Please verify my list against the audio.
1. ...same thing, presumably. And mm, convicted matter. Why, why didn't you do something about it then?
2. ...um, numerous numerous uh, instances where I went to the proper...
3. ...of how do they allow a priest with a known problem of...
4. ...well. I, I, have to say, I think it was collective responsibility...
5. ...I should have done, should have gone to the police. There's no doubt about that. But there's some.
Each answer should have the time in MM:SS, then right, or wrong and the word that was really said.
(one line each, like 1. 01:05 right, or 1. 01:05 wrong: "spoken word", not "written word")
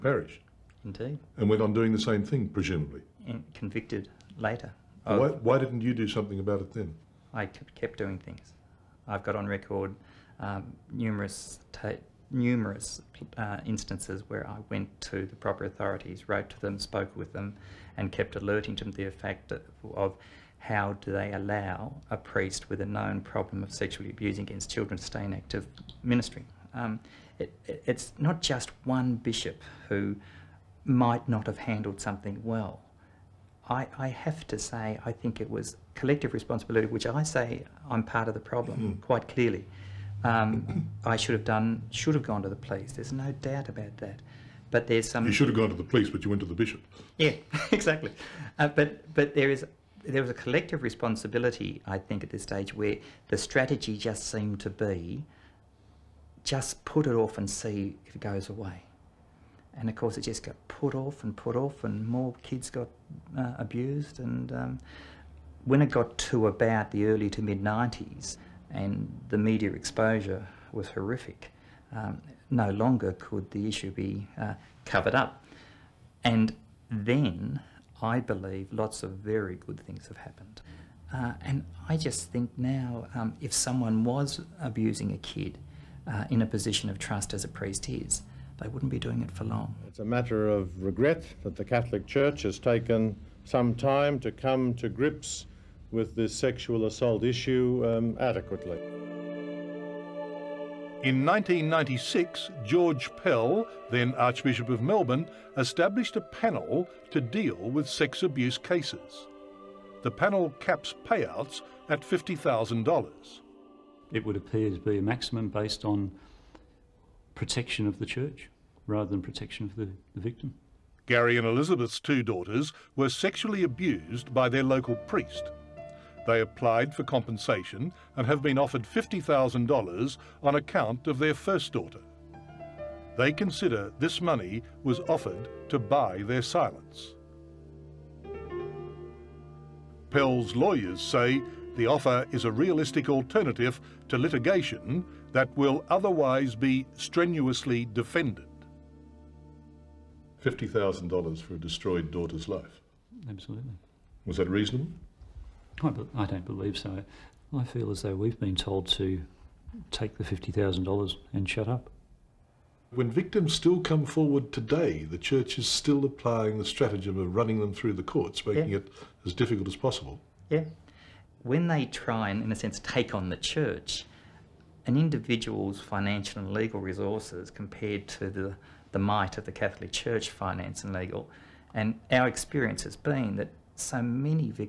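1. 00:01 wrong: "later", not "matter"
2. 00:10 right
3. 00:19 right
4. 00:32 right
5. 00:41 right.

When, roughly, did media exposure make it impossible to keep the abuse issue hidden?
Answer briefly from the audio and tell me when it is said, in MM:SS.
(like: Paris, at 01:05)
early to mid 90s, at 01:07.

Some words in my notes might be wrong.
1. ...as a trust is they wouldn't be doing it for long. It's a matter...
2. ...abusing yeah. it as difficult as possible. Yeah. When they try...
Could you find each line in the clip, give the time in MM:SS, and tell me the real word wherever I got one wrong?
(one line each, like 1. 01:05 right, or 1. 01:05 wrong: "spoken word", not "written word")
1. 01:27 wrong: "priest", not "trust"
2. 02:48 wrong: "making", not "abusing".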